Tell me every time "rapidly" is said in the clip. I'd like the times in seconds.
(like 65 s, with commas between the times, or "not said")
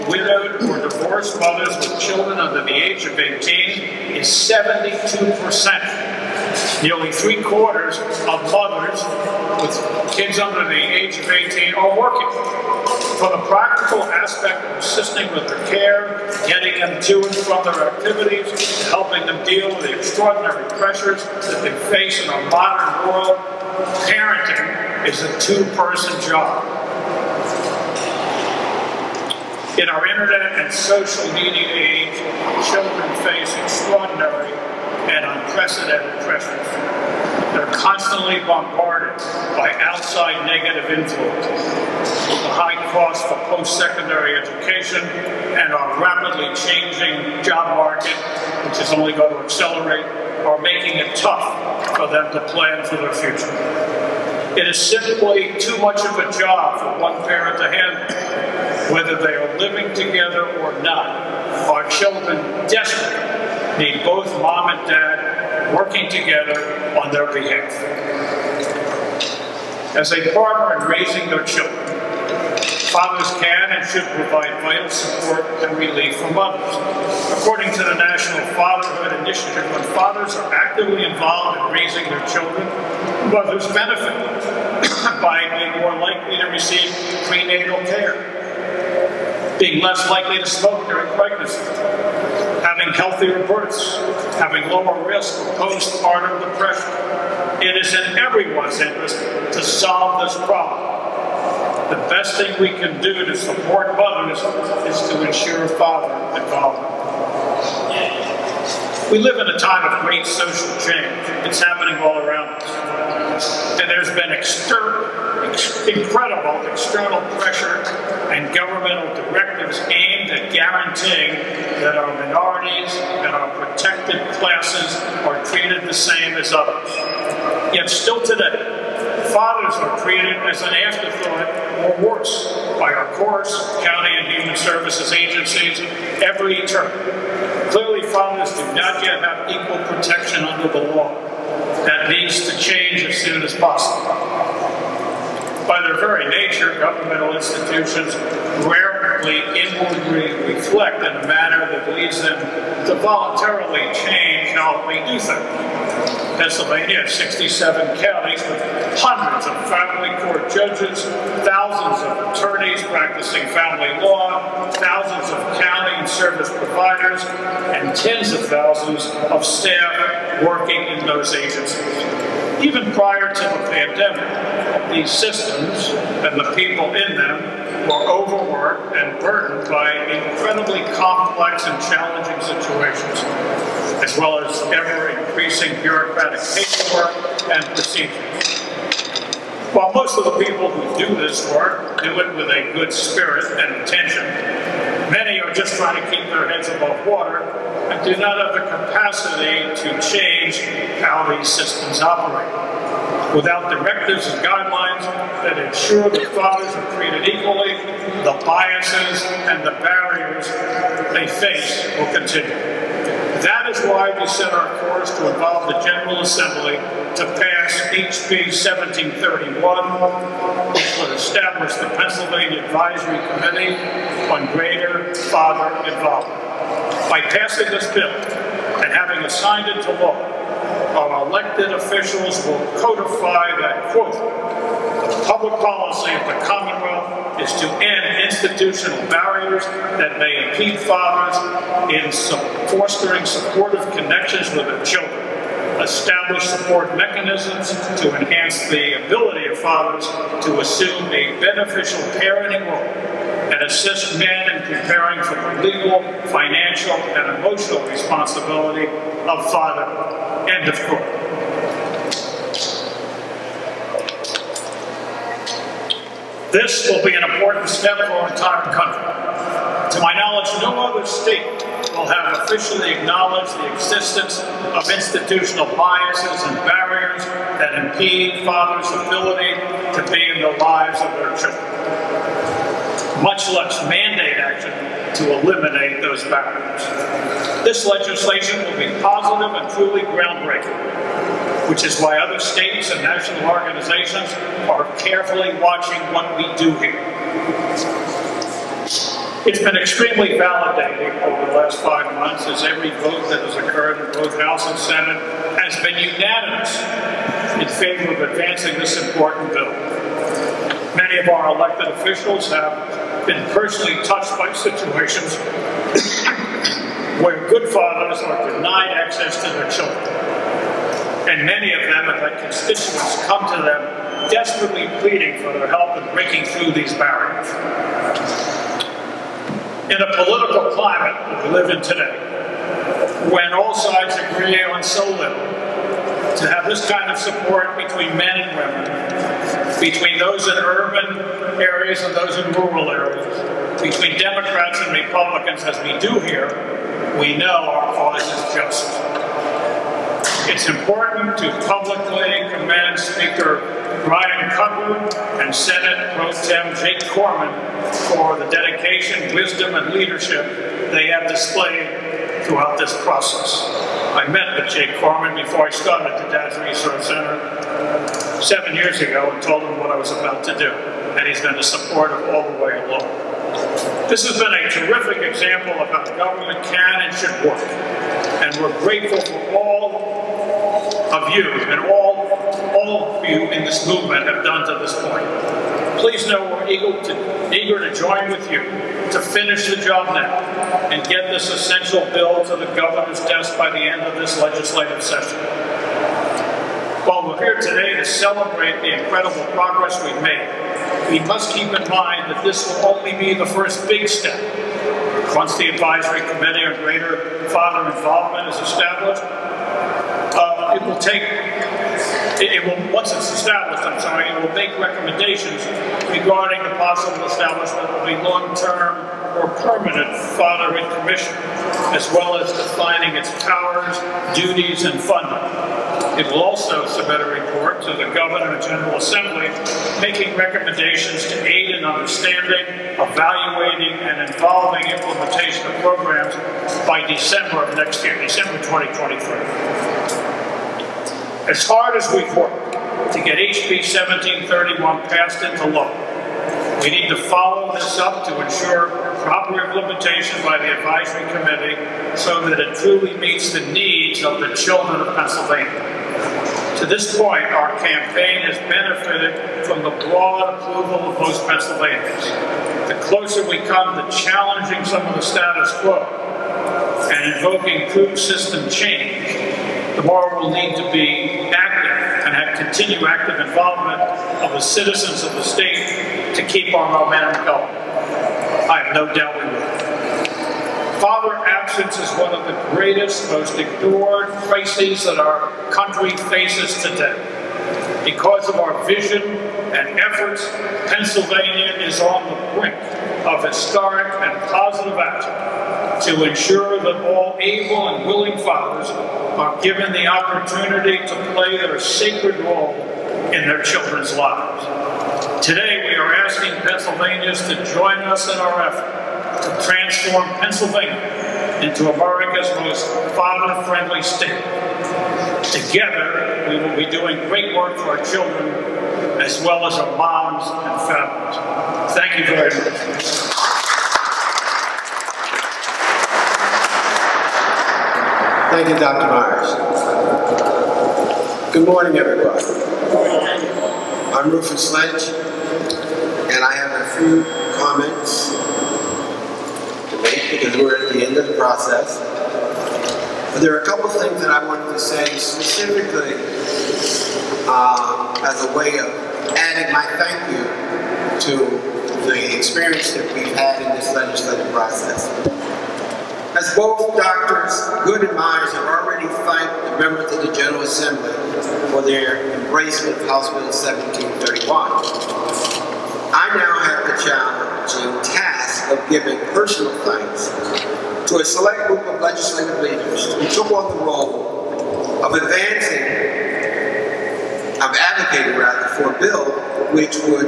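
46 s.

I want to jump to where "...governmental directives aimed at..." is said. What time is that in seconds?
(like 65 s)
118 s.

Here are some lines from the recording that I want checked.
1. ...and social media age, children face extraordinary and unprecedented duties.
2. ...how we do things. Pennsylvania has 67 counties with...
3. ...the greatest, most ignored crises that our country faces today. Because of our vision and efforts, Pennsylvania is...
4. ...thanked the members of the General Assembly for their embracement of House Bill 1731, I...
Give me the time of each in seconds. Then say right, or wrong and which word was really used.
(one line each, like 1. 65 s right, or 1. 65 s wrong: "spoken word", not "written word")
1. 30 s wrong: "pressures", not "duties"
2. 154 s right
3. 482 s right
4. 559 s right.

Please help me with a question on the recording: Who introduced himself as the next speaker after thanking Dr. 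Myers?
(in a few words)
Rufus Lynch.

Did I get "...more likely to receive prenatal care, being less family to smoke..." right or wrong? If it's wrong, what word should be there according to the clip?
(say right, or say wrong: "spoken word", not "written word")
wrong: "likely", not "family".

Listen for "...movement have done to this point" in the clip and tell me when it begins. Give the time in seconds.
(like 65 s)
383 s.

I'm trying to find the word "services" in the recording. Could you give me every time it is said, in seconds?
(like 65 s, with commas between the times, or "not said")
134 s, 166 s.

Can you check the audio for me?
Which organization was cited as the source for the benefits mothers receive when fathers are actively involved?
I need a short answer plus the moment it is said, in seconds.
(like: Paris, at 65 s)
National Fatherhood Initiative, at 77 s.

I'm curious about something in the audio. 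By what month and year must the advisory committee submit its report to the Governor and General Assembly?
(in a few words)
December 2023.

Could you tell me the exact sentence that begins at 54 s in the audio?
It is simply too much of a job for one parent to handle.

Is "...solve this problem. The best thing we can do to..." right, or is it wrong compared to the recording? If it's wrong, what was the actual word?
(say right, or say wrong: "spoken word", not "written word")
right.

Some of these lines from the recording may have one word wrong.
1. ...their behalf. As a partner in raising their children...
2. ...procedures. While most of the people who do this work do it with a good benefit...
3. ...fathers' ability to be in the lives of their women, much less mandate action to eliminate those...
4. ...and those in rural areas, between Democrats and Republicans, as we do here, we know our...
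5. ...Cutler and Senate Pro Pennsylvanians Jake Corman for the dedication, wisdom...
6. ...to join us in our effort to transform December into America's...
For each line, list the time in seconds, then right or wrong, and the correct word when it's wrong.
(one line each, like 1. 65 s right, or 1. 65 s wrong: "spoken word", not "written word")
1. 67 s right
2. 187 s wrong: "spirit", not "benefit"
3. 278 s wrong: "children", not "women"
4. 342 s right
5. 354 s wrong: "Tem", not "Pennsylvanians"
6. 507 s wrong: "Pennsylvania", not "December".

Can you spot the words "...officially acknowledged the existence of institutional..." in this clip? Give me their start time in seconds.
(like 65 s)
272 s.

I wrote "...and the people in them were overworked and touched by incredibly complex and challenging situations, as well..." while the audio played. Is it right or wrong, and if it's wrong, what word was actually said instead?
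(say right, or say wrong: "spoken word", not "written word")
wrong: "burdened", not "touched".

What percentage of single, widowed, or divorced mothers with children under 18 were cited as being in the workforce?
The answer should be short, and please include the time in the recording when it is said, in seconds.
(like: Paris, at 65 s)
72 percent, at 4 s.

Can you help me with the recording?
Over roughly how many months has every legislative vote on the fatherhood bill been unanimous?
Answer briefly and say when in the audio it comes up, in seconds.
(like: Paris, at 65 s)
5, at 301 s.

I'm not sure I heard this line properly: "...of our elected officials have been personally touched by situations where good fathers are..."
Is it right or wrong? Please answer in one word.
right.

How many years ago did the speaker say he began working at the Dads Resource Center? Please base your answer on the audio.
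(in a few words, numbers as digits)
7.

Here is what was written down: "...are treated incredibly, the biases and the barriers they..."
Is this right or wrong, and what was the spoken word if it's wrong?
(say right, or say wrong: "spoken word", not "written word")
wrong: "equally", not "incredibly".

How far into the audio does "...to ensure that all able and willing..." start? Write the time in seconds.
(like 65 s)
496 s.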